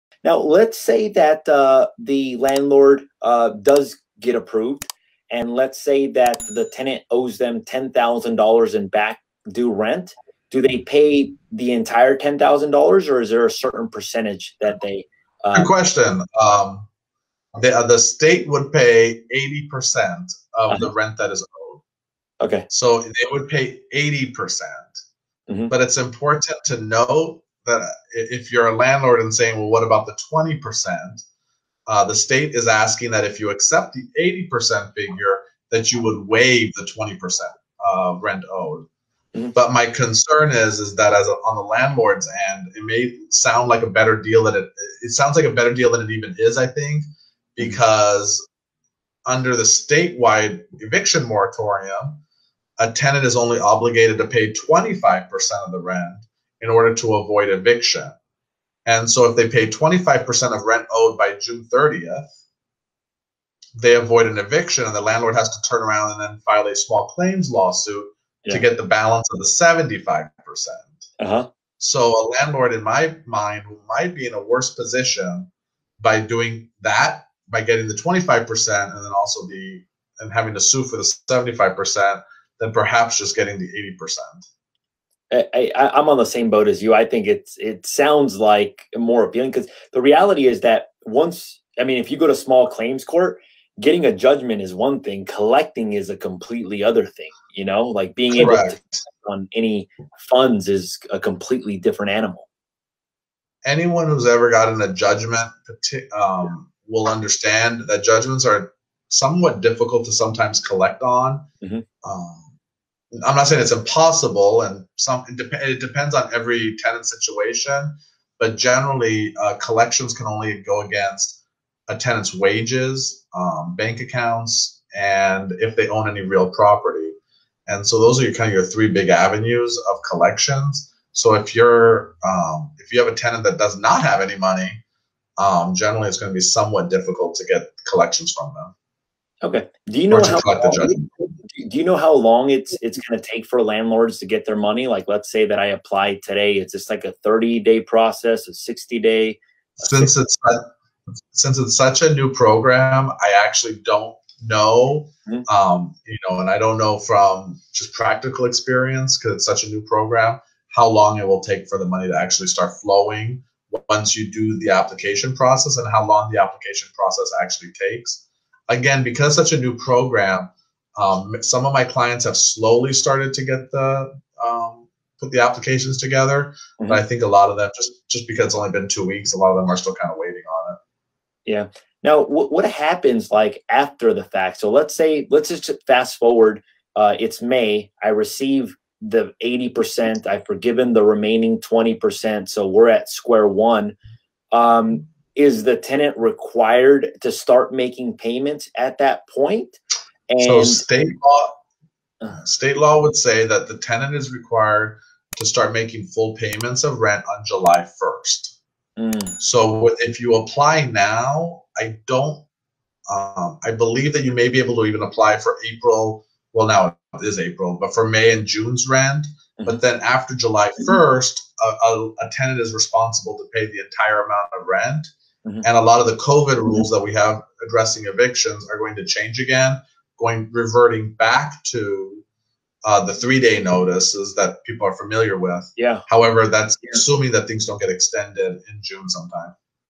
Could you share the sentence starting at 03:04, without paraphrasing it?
So let's say let's just fast forward.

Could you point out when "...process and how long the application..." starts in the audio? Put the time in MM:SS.
02:45.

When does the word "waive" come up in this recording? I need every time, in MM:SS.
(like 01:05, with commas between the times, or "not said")
00:36.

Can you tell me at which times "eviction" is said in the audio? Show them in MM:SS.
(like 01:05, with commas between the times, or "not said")
00:50, 00:57, 01:04, 03:48.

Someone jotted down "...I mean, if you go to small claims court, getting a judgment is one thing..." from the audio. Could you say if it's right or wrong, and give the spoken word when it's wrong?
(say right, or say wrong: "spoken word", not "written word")
right.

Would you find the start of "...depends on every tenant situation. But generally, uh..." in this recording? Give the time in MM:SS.
01:55.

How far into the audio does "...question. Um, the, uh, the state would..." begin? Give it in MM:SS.
00:15.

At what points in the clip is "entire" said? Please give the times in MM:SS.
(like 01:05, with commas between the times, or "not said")
00:11, 03:43.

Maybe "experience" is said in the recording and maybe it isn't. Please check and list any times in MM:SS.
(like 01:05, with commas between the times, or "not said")
02:38.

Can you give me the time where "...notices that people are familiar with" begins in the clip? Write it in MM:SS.
03:53.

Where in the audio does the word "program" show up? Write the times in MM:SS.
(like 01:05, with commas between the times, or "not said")
02:32, 02:39, 02:49.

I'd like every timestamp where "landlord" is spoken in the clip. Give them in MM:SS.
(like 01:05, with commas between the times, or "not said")
00:02, 00:28, 00:41, 01:05, 01:12, 02:23.